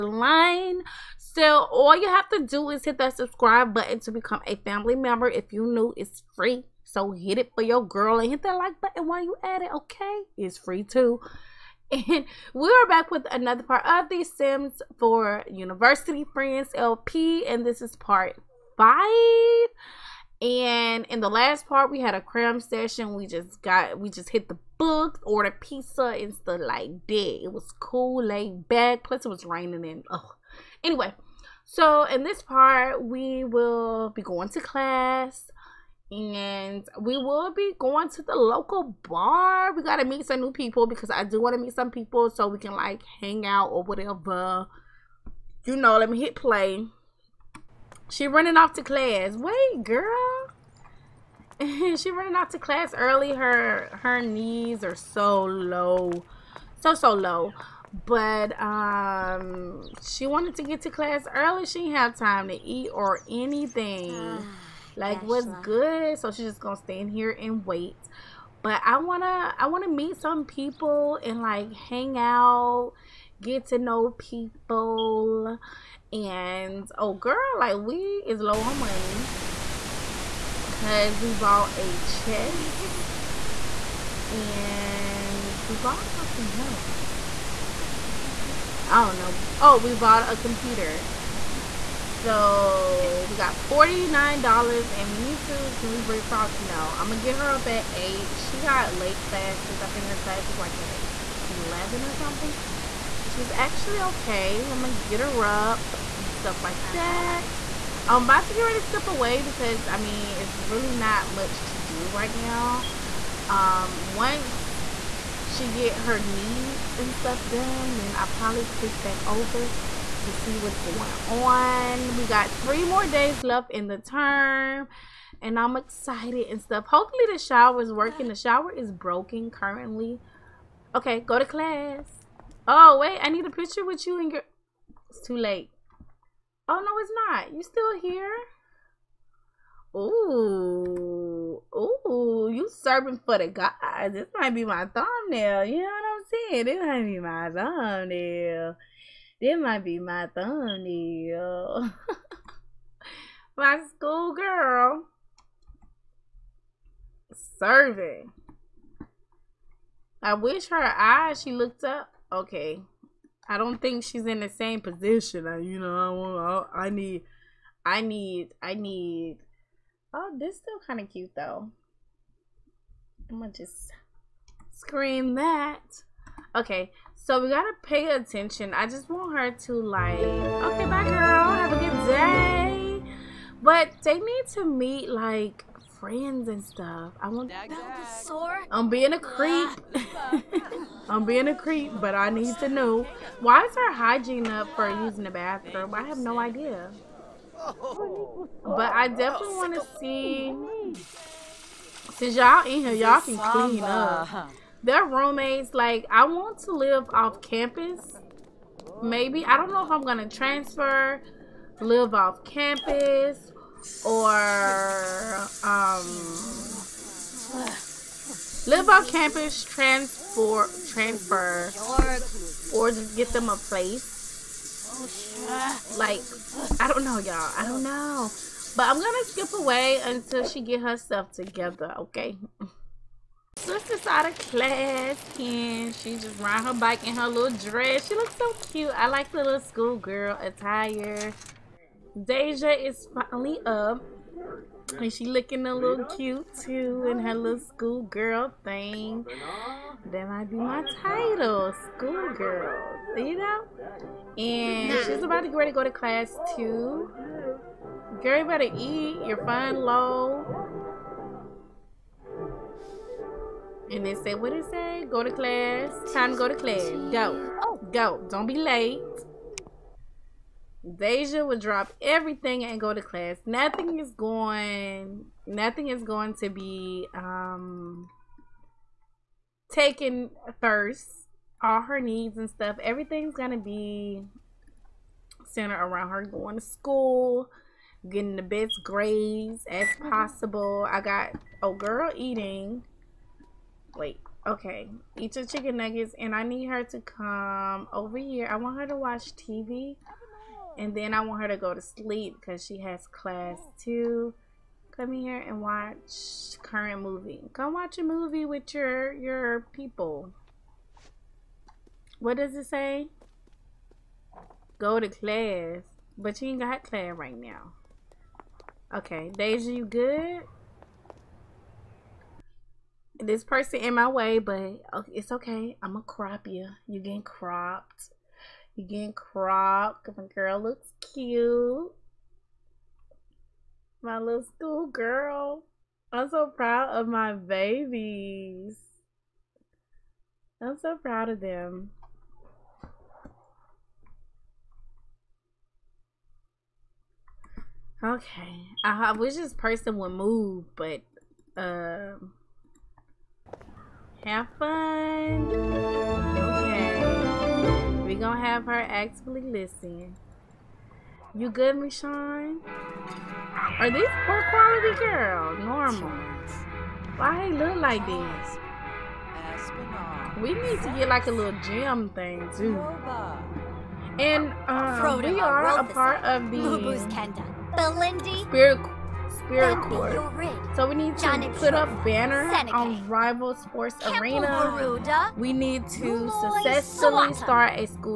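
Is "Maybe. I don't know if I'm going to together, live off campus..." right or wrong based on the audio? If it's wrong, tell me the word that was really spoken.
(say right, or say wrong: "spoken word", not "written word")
wrong: "transfer", not "together".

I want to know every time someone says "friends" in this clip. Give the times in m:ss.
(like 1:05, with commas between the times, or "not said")
0:16, 3:05.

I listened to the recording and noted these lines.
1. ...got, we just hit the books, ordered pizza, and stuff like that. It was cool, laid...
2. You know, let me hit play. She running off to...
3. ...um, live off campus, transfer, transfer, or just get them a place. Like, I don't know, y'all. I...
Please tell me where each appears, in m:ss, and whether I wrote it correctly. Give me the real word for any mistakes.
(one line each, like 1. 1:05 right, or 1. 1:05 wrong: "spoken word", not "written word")
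1. 0:23 right
2. 0:45 right
3. 3:35 right.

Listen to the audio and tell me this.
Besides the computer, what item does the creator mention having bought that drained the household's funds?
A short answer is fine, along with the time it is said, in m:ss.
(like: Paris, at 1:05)
A chest, at 1:21.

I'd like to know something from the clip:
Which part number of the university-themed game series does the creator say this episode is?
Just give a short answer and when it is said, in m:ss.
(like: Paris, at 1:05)
5, at 0:17.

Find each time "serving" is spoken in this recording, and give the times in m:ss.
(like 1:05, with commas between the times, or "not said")
2:22, 2:37.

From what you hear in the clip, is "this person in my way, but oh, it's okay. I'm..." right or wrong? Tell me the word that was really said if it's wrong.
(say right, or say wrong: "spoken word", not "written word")
right.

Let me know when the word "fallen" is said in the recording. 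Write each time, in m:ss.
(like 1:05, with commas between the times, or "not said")
not said.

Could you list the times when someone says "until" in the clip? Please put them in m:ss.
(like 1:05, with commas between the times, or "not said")
3:50.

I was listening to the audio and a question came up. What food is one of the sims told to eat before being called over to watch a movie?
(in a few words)
Chicken nuggets.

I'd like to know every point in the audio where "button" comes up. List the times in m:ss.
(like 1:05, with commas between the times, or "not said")
0:03, 0:08.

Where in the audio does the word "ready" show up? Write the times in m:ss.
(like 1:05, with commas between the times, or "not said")
1:48, 4:15.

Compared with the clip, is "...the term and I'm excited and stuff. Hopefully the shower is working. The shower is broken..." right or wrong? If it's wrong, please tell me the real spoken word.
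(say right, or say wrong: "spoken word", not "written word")
right.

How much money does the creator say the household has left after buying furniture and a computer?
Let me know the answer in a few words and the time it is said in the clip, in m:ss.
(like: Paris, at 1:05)
$49, at 1:33.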